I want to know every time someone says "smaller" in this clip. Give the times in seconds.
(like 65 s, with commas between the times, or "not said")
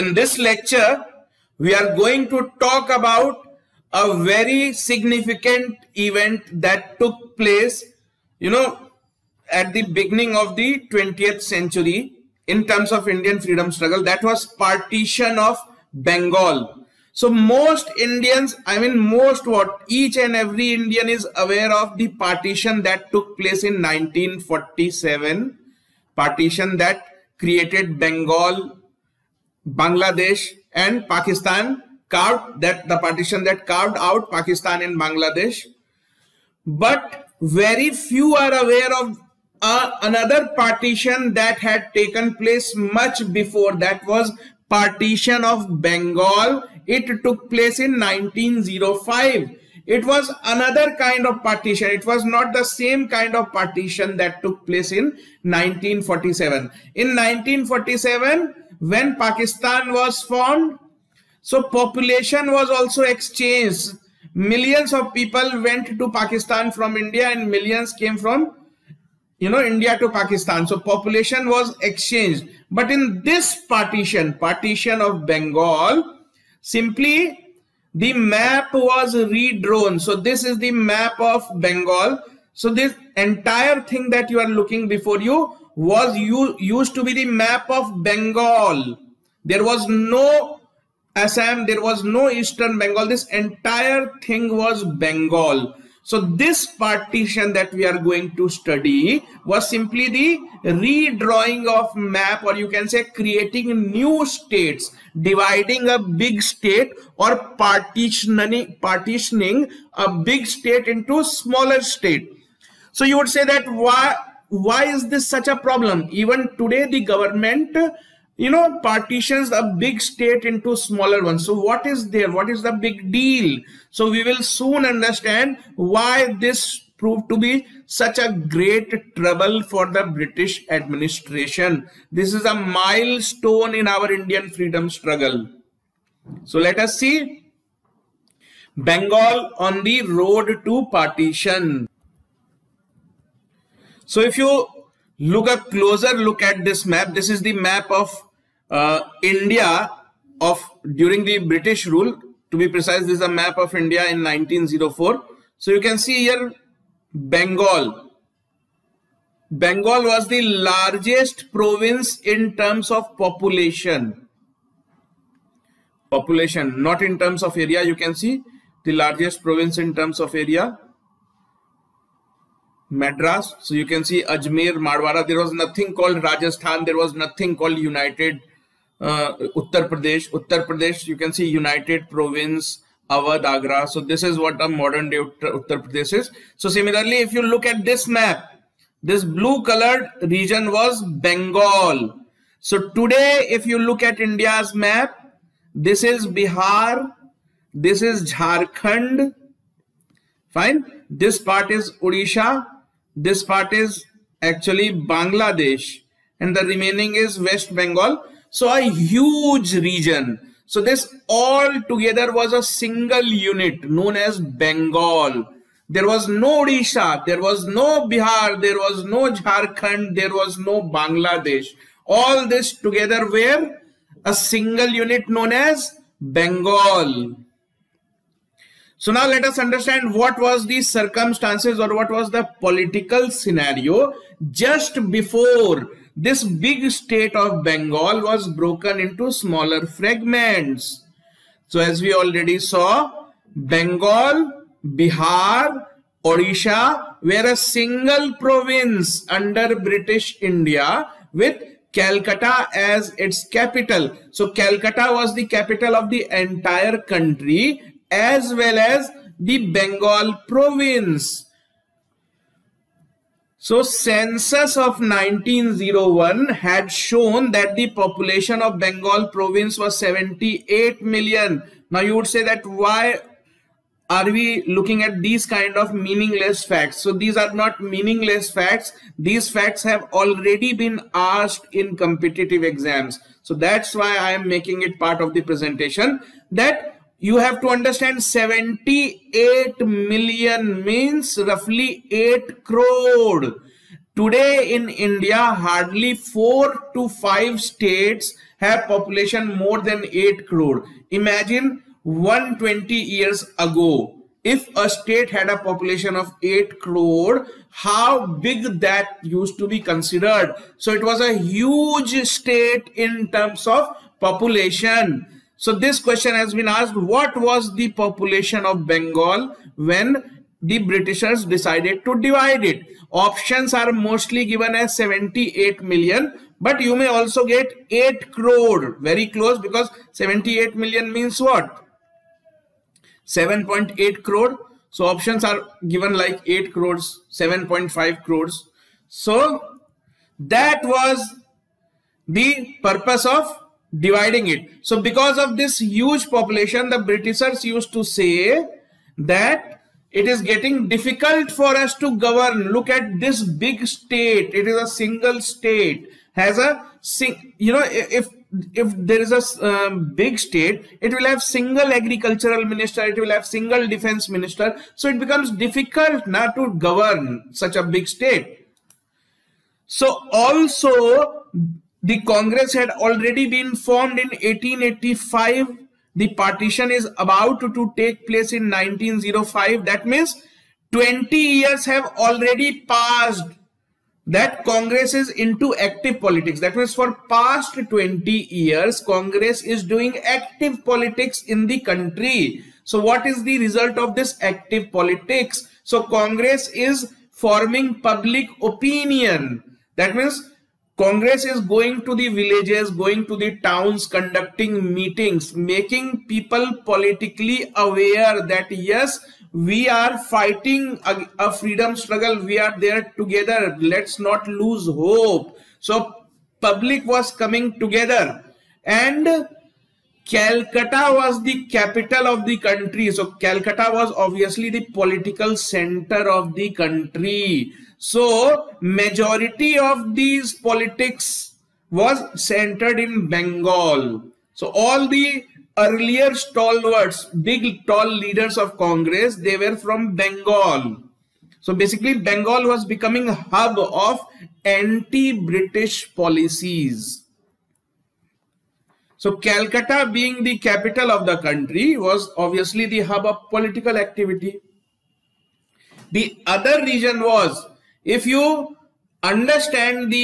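111 s, 120 s, 239 s.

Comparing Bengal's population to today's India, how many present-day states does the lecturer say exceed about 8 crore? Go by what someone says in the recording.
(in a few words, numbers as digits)
4 to 5.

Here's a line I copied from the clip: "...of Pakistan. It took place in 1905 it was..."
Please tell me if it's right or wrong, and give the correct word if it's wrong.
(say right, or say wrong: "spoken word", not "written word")
wrong: "Bengal", not "Pakistan".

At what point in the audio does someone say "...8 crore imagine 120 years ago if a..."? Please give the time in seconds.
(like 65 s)
300 s.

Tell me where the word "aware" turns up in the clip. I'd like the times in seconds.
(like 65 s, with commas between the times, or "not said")
21 s, 38 s, 407 s.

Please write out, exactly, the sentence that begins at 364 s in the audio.
So it becomes difficult not to govern such a big state.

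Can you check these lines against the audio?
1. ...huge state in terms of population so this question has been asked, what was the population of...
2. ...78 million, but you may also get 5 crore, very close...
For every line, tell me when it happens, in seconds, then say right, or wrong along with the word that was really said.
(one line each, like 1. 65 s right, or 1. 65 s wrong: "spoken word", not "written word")
1. 311 s right
2. 324 s wrong: "8", not "5".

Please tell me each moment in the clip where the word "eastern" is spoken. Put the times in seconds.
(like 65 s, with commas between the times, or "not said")
92 s.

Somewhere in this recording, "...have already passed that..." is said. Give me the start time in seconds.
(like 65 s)
381 s.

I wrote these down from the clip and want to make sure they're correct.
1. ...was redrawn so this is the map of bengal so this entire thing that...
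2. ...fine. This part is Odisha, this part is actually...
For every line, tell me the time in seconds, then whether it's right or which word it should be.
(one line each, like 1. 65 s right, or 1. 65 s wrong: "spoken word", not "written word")
1. 78 s right
2. 200 s right.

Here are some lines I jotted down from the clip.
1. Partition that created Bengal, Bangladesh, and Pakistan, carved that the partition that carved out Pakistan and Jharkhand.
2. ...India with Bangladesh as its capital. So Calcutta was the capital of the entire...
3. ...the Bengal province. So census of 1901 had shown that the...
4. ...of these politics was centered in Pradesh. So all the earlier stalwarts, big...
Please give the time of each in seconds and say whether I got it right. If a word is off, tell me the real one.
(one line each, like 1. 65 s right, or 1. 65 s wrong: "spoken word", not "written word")
1. 26 s wrong: "Bangladesh", not "Jharkhand"
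2. 250 s wrong: "Calcutta", not "Bangladesh"
3. 259 s right
4. 429 s wrong: "Bengal", not "Pradesh".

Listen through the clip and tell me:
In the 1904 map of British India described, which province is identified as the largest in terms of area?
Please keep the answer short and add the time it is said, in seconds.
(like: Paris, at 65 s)
Madras, at 172 s.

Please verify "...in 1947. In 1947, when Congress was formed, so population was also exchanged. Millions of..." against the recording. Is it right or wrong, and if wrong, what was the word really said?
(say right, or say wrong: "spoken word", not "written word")
wrong: "Pakistan", not "Congress".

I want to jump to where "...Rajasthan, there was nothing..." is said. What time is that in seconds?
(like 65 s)
176 s.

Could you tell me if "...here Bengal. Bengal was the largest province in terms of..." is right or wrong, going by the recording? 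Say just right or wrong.
right.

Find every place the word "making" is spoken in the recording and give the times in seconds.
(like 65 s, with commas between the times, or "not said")
284 s, 405 s.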